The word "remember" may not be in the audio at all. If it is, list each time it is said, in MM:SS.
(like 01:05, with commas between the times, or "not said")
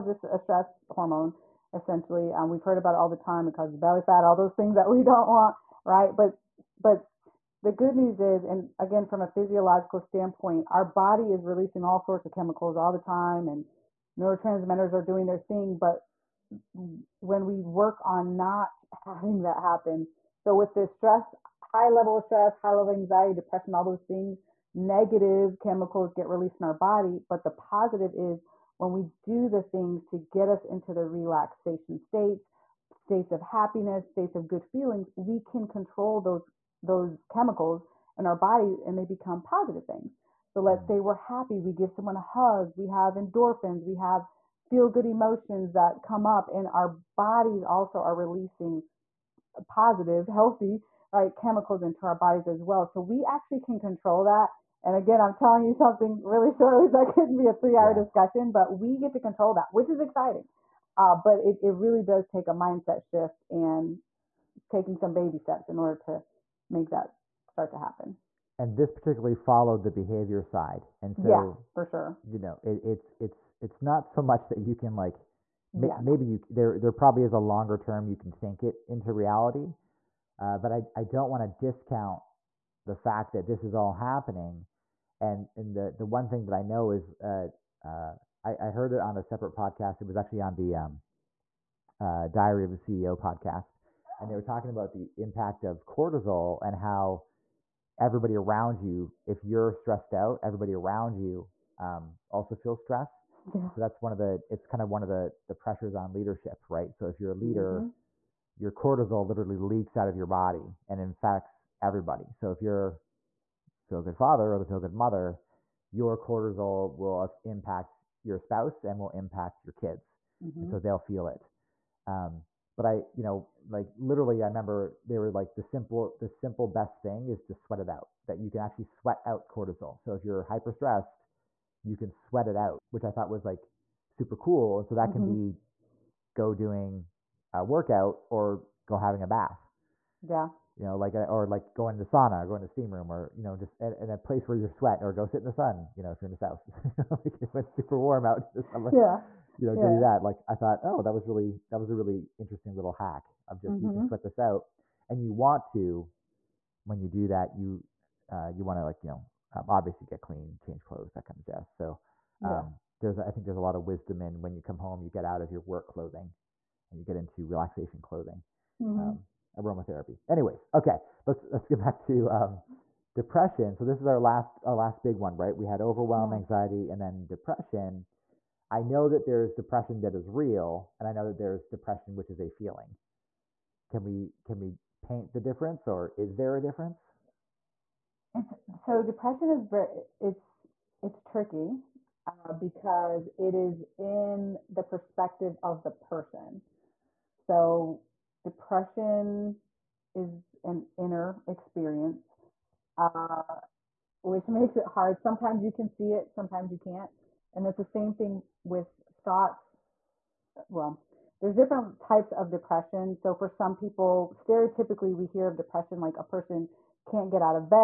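02:04.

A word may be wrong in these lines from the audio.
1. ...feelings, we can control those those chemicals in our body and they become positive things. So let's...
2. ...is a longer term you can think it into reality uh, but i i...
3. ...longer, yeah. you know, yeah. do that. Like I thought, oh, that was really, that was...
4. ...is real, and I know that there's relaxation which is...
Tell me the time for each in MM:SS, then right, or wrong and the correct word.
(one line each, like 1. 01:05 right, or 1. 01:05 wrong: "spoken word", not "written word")
1. 00:34 right
2. 01:17 right
3. 02:28 wrong: "summer", not "longer"
4. 03:00 wrong: "depression", not "relaxation".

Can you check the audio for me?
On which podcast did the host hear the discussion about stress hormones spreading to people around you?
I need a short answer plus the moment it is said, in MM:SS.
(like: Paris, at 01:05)
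Diary of a CEO, at 01:32.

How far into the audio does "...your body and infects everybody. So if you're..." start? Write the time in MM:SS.
01:50.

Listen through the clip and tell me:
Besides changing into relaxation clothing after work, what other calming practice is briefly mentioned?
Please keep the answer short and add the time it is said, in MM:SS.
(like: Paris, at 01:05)
Aromatherapy, at 02:49.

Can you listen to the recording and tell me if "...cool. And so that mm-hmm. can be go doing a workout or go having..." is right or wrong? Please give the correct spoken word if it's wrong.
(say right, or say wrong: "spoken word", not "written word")
right.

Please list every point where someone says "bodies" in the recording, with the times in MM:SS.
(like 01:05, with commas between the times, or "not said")
00:47, 00:52.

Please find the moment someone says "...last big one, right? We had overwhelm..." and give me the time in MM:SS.
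02:54.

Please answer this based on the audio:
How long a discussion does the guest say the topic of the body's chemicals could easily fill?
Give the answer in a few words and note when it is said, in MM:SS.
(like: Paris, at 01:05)
3 hours, at 00:57.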